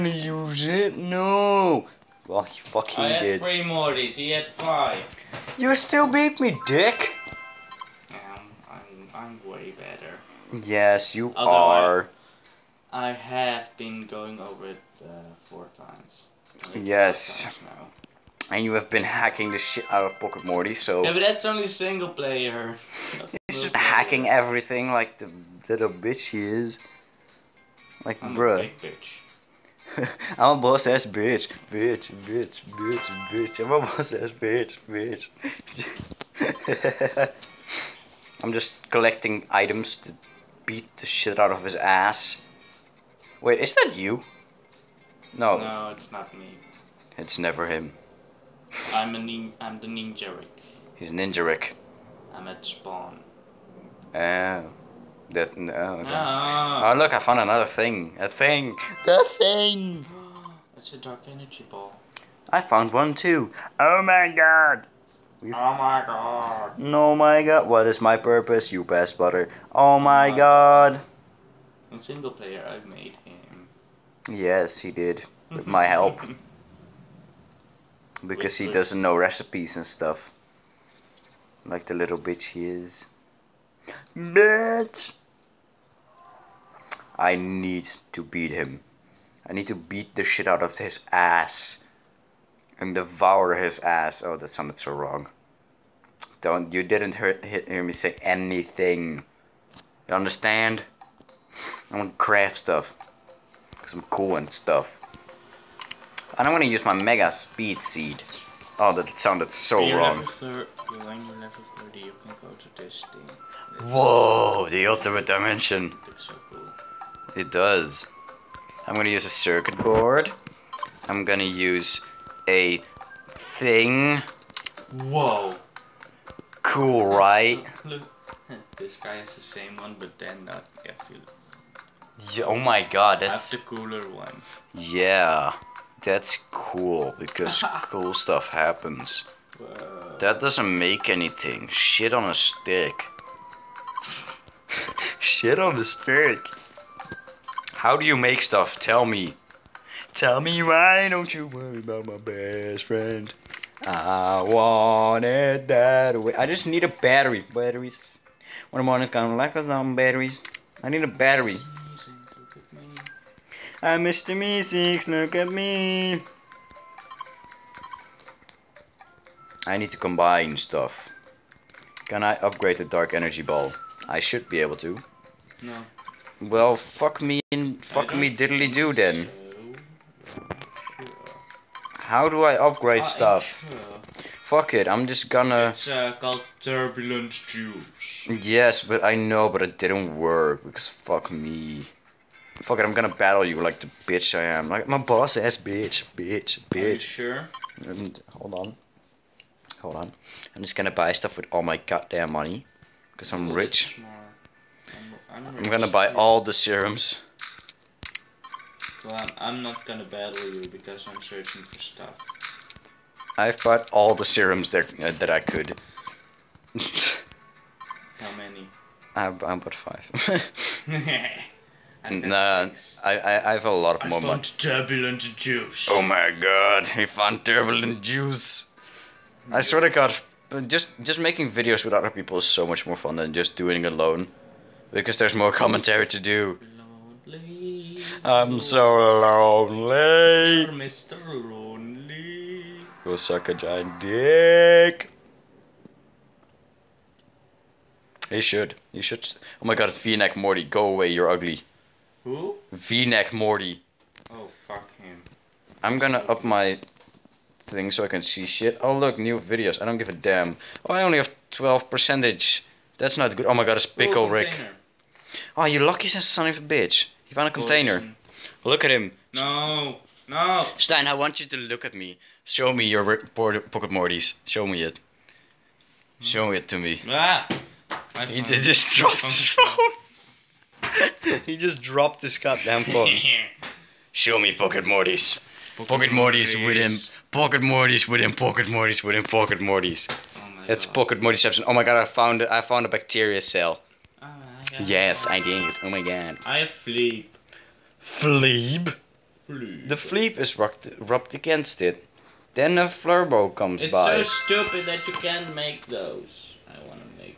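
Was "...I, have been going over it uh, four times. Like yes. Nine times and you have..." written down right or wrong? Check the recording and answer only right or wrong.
wrong.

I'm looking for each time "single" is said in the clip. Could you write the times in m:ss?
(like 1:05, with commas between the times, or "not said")
0:21, 1:12.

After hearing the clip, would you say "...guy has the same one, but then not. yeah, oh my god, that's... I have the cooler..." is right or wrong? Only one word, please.
right.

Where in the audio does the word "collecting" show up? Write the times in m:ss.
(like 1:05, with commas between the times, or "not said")
0:38.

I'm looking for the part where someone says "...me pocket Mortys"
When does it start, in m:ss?
4:44.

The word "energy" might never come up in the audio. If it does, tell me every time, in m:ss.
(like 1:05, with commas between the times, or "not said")
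1:01, 2:53.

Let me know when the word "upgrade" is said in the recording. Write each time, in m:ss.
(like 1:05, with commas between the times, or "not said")
2:52, 3:02.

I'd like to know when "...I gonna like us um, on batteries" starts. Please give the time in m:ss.
2:39.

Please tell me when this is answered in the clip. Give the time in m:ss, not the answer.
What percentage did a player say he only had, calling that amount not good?
4:21.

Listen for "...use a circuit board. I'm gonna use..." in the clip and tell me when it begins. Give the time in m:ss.
1:59.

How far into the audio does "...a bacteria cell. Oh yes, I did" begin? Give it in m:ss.
4:52.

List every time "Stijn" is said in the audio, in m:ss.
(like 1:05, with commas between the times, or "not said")
4:30.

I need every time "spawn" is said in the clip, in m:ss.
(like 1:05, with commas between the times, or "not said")
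0:52.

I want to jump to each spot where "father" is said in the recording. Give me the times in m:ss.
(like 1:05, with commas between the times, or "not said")
not said.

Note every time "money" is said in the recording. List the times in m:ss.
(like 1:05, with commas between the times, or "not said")
3:22, 3:44.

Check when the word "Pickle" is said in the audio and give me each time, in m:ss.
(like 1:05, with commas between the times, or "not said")
4:23.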